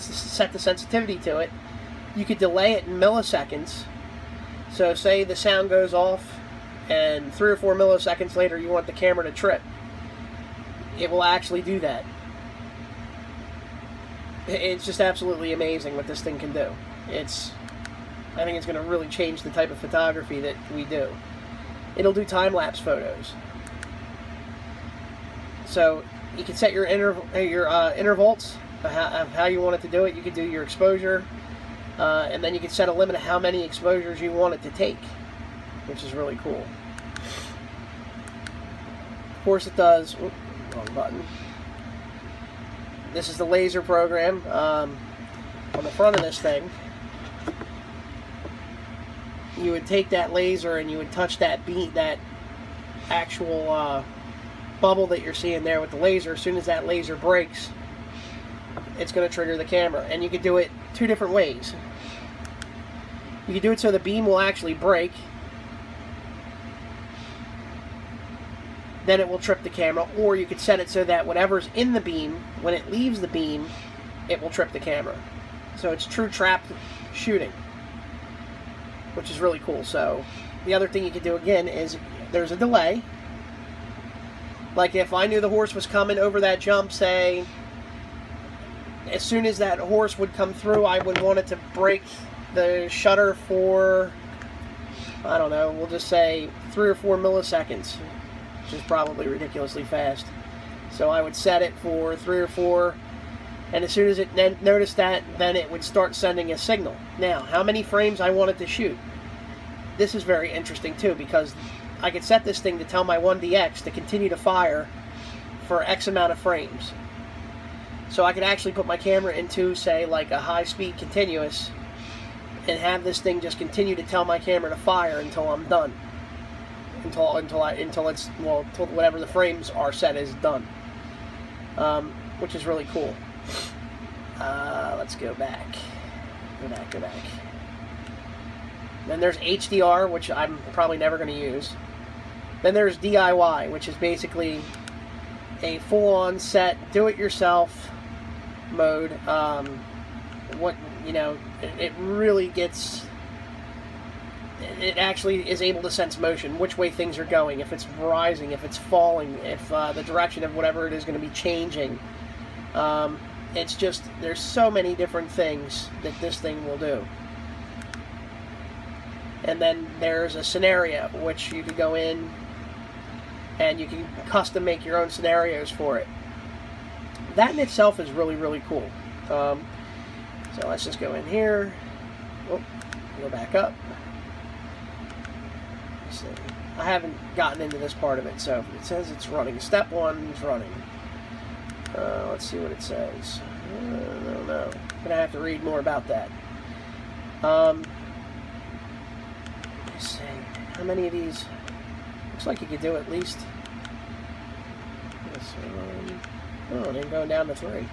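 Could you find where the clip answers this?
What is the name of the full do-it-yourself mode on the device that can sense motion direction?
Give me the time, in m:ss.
2:22.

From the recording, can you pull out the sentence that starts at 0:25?
So you can set your interval, uh, your uh, intervals of how, you want it to do it.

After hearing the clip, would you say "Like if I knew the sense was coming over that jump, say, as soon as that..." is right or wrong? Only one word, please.
wrong.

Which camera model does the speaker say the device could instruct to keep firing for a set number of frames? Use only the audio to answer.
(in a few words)
1DX.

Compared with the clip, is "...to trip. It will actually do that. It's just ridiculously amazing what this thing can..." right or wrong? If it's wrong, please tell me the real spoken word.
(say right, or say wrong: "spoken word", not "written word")
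wrong: "absolutely", not "ridiculously".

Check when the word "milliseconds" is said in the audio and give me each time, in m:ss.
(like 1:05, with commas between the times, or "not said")
0:02, 0:07, 1:37.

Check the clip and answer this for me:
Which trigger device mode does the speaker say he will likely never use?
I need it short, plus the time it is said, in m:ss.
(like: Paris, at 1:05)
HDR, at 2:19.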